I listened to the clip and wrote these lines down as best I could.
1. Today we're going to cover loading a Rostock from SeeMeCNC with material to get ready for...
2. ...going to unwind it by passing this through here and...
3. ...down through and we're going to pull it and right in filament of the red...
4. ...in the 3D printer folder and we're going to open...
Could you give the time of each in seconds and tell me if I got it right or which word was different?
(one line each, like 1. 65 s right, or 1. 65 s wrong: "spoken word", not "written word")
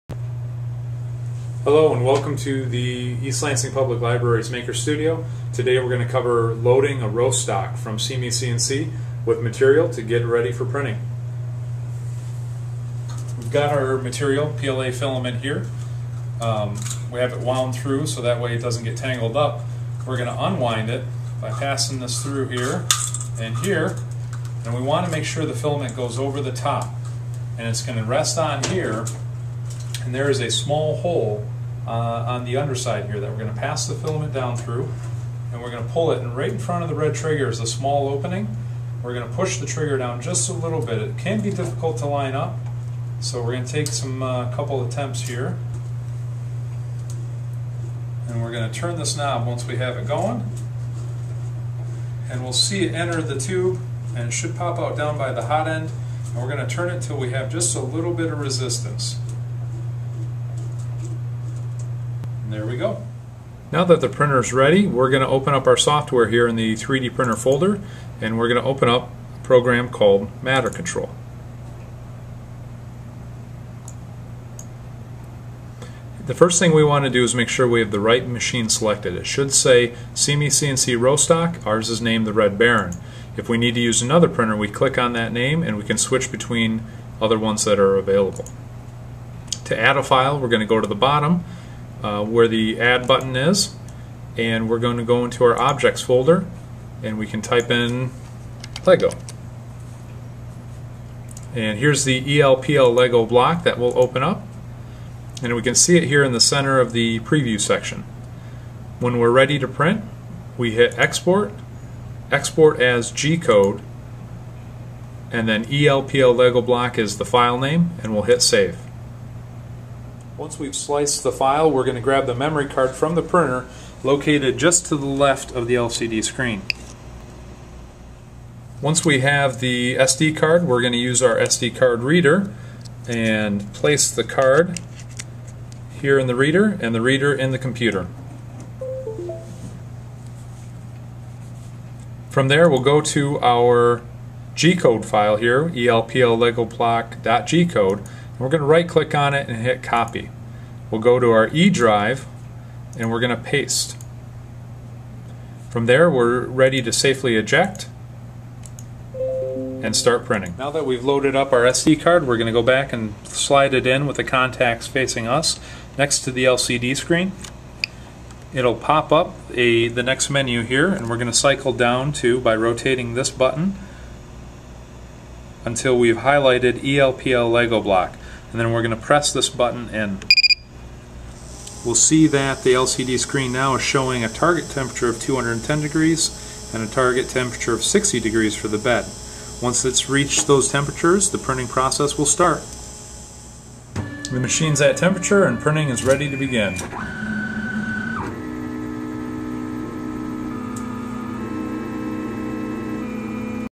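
1. 5 s right
2. 20 s right
3. 34 s wrong: "front", not "filament"
4. 66 s right.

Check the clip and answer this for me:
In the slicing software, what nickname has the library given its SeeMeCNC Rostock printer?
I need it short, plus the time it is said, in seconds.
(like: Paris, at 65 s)
Red Baron, at 82 s.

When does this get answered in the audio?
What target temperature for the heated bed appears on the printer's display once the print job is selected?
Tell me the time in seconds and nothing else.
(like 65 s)
187 s.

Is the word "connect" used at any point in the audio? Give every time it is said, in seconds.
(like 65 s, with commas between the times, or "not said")
not said.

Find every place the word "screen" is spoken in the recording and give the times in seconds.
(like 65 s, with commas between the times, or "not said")
126 s, 166 s, 183 s.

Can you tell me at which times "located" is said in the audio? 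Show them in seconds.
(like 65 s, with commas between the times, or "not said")
124 s.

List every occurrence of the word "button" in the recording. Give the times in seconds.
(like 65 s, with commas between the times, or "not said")
93 s, 173 s, 179 s.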